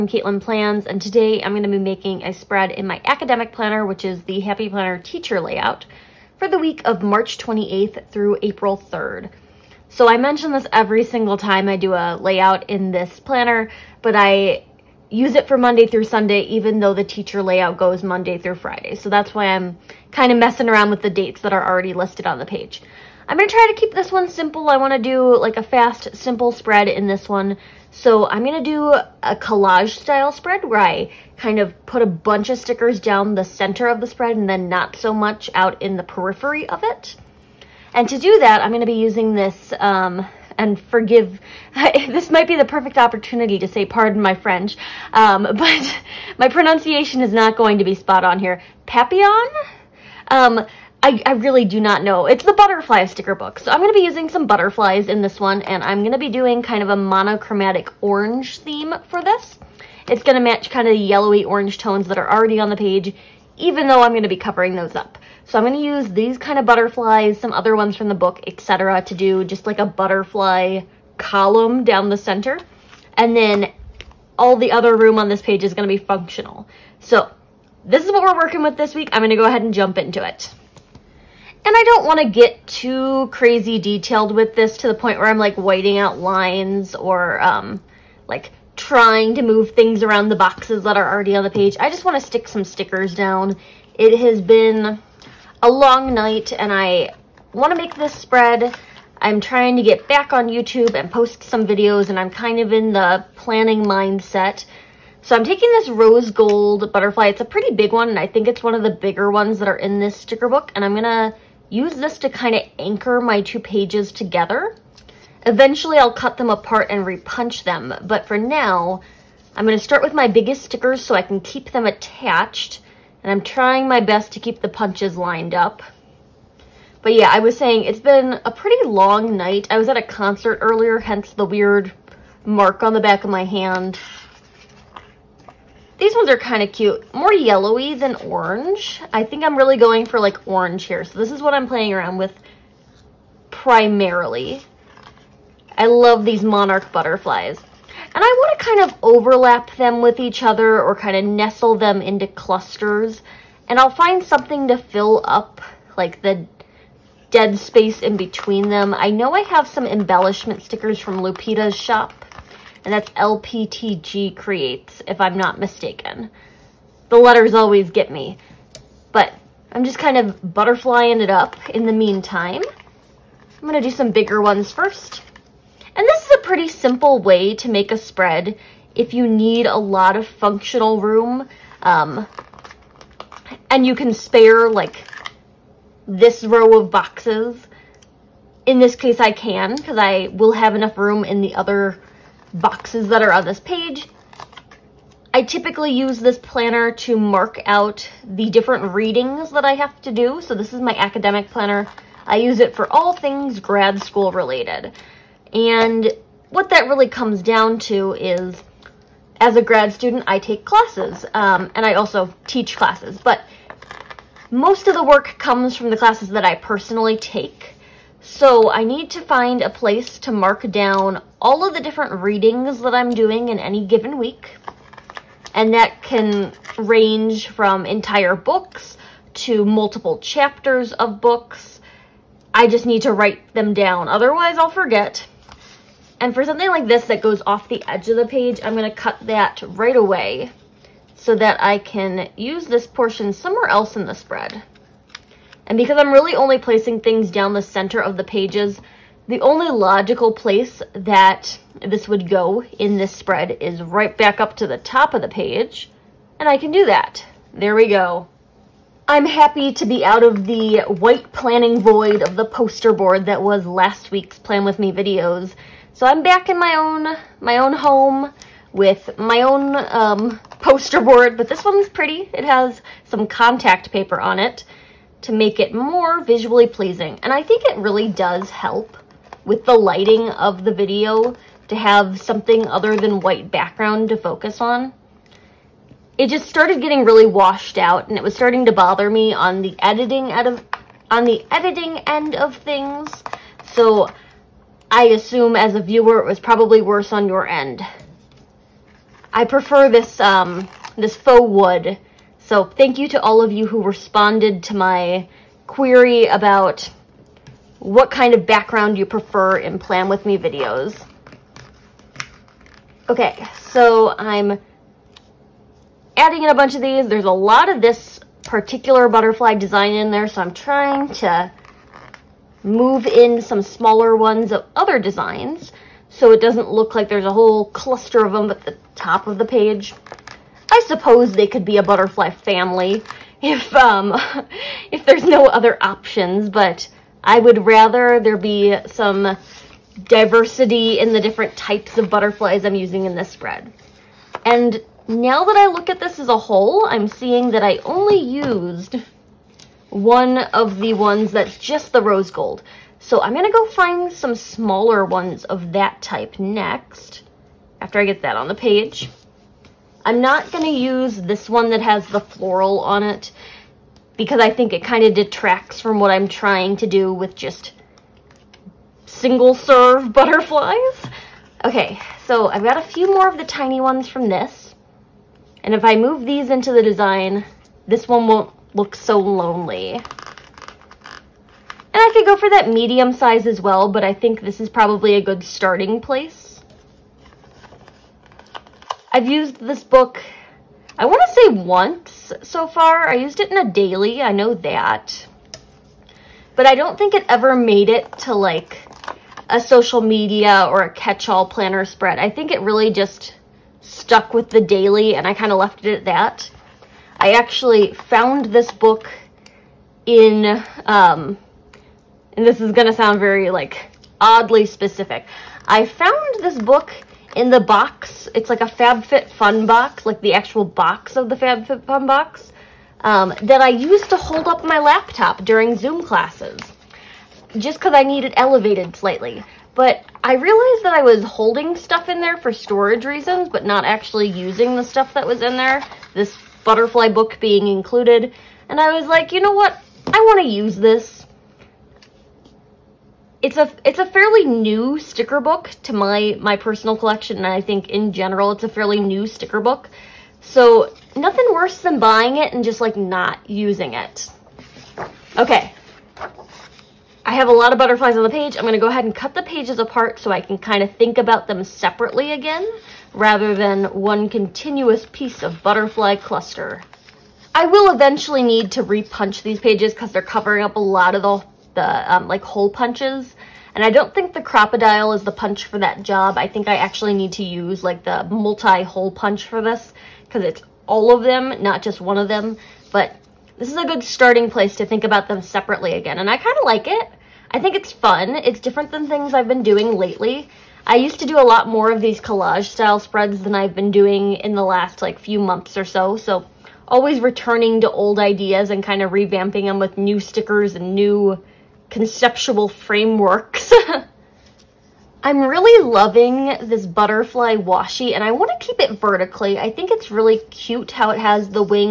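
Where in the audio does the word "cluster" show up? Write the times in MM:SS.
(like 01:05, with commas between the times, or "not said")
02:32, 05:27, 07:46.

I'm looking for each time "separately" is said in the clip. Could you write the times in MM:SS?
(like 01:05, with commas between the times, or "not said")
07:41, 08:05.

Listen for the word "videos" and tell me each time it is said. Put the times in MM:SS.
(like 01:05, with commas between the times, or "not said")
01:41, 04:24, 04:40, 05:10.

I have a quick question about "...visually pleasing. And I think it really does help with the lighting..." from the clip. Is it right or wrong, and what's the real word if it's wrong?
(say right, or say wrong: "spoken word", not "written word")
right.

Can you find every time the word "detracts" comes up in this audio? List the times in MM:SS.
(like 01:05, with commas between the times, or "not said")
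06:05.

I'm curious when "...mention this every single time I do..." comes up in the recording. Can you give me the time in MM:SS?
00:10.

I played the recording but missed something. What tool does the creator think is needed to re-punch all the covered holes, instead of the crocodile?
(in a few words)
multi-hole punch.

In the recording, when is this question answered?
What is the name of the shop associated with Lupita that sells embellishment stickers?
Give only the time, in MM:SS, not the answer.
02:43.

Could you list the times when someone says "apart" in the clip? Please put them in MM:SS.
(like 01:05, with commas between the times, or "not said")
01:56, 07:39.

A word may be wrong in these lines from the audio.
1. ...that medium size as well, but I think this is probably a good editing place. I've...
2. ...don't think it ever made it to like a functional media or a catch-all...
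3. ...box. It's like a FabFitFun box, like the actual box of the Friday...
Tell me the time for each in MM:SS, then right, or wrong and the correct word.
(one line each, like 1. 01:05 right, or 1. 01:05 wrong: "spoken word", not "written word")
1. 06:22 wrong: "starting", not "editing"
2. 06:36 wrong: "social", not "functional"
3. 06:57 wrong: "FabFitFun", not "Friday".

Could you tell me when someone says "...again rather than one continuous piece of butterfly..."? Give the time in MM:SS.
07:42.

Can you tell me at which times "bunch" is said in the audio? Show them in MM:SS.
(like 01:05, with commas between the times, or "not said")
00:32, 05:16.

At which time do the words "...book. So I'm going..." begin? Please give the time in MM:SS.
00:53.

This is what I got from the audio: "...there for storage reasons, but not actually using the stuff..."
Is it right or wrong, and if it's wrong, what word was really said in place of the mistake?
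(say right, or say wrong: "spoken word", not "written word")
right.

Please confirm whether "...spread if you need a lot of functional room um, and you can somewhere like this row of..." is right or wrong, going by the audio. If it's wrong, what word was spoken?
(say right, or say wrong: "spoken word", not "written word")
wrong: "spare", not "somewhere".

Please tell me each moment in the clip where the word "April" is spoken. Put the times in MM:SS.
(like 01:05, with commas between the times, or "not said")
00:08.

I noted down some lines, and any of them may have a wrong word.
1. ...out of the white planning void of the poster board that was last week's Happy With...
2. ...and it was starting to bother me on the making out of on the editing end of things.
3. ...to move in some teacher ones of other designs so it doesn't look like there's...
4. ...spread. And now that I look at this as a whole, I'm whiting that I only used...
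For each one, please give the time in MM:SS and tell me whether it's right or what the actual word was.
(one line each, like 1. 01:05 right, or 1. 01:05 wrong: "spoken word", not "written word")
1. 04:20 wrong: "Plan", not "Happy"
2. 04:48 wrong: "editing", not "making"
3. 05:21 wrong: "smaller", not "teacher"
4. 05:43 wrong: "seeing", not "whiting".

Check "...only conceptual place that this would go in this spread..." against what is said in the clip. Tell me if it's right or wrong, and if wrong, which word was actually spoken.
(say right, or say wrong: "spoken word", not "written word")
wrong: "logical", not "conceptual".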